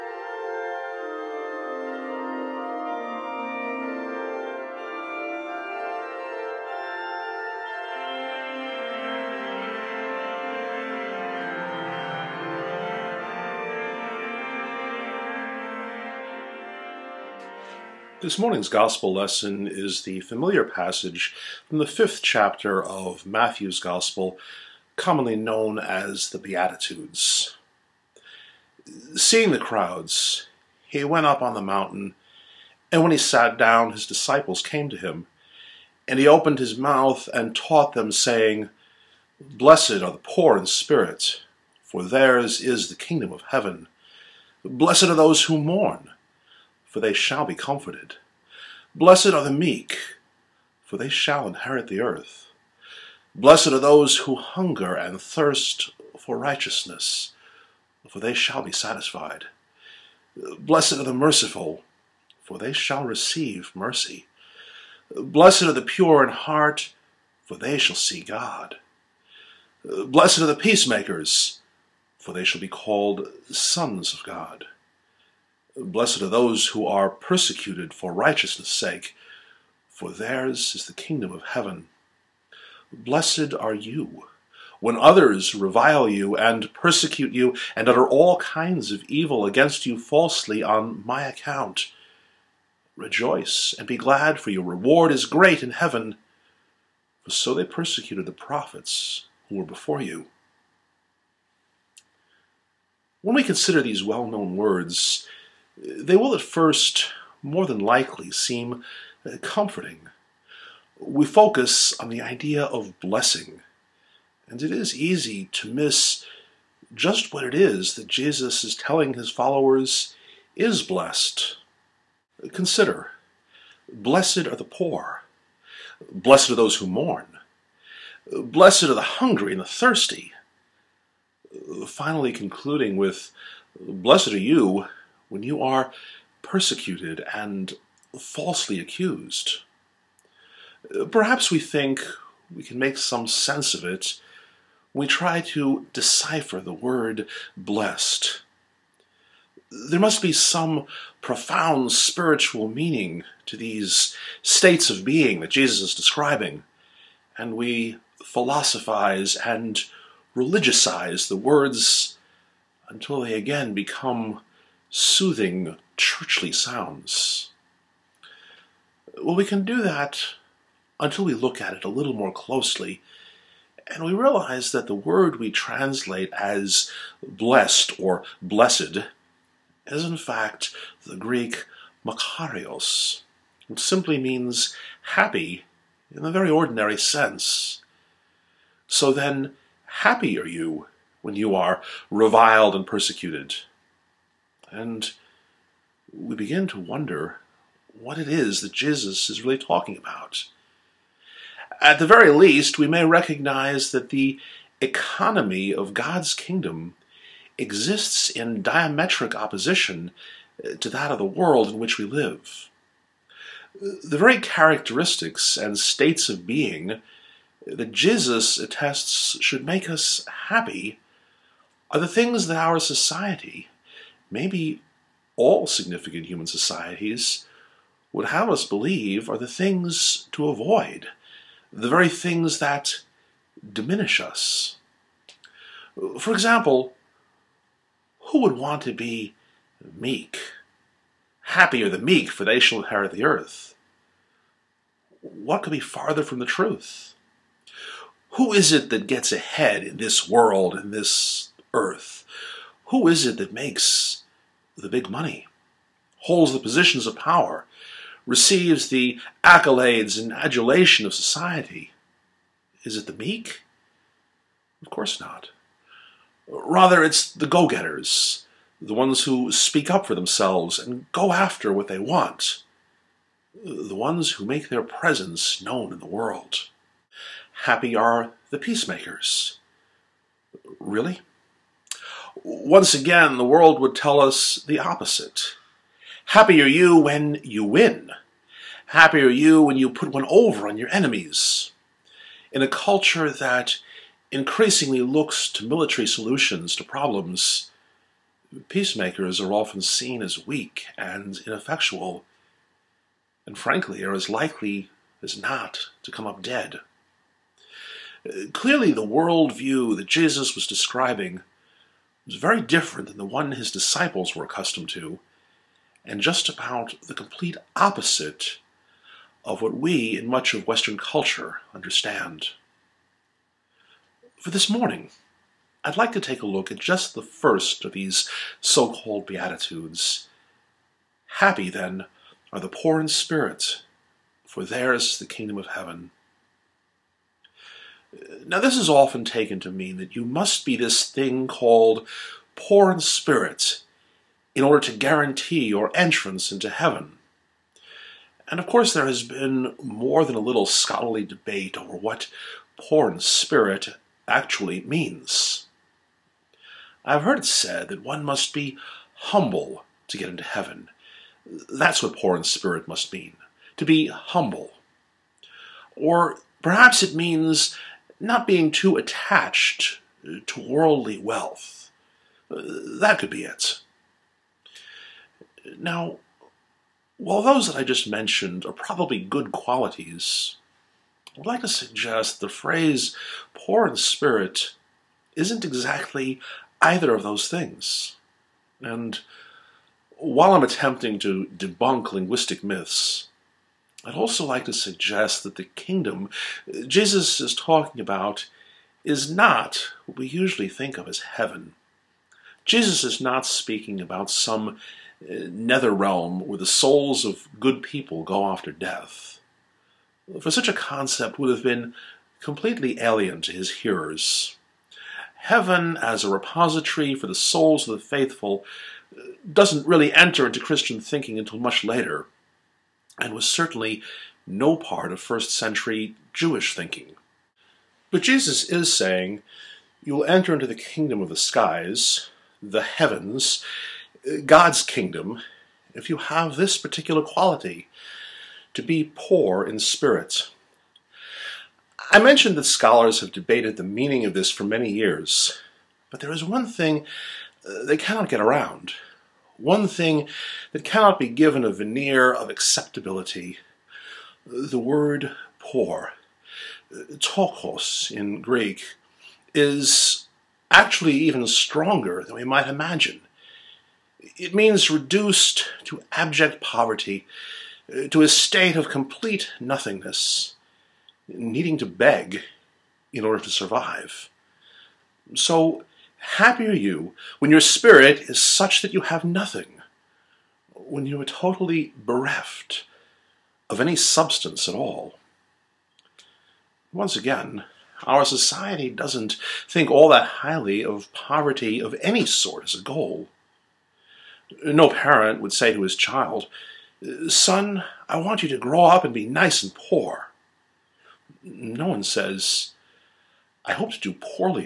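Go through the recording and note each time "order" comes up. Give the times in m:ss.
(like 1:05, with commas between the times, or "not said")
5:44, 7:53.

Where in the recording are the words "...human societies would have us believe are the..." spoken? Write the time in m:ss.
3:46.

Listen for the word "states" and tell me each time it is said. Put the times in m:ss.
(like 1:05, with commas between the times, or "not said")
2:34, 3:35, 7:48.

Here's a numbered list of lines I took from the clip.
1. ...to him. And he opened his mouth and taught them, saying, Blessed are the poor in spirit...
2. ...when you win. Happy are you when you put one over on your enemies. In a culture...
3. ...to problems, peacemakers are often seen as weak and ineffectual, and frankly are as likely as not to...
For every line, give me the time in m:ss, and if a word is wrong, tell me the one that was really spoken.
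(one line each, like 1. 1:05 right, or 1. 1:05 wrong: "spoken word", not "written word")
1. 0:34 right
2. 4:46 right
3. 4:56 right.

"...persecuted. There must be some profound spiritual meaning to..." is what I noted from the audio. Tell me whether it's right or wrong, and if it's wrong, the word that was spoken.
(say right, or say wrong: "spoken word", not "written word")
wrong: "blessed", not "persecuted".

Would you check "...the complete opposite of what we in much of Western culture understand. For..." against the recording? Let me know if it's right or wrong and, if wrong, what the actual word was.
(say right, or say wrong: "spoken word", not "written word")
right.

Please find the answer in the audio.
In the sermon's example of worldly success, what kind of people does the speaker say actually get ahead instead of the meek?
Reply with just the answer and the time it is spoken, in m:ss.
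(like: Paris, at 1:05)
Go getters, at 4:27.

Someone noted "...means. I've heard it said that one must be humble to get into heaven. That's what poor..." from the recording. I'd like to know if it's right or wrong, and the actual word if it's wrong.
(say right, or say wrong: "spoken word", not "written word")
right.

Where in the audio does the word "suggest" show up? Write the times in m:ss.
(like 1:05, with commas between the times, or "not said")
6:21, 6:34.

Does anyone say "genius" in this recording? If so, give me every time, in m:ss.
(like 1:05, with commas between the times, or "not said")
not said.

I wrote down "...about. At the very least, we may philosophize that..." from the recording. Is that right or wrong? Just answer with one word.
wrong.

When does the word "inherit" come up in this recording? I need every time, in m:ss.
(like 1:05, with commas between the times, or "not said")
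0:51, 4:02.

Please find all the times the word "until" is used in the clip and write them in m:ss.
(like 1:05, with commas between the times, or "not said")
2:42, 2:50, 7:01.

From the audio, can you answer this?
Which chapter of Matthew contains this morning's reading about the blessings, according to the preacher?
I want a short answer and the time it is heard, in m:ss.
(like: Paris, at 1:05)
Fifth, at 0:21.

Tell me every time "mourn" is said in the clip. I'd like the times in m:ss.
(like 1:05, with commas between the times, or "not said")
0:45, 2:06.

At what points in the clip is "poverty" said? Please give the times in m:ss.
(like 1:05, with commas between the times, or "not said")
7:46, 8:11.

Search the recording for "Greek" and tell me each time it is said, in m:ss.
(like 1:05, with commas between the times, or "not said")
3:01, 7:38.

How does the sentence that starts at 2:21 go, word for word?
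Perhaps we think we can make some sense of it.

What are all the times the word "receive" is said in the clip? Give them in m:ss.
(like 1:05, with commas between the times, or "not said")
1:03, 4:18.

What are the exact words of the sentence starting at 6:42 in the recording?
Jesus is not speaking about some uh, nether realm where the souls of good people go after death.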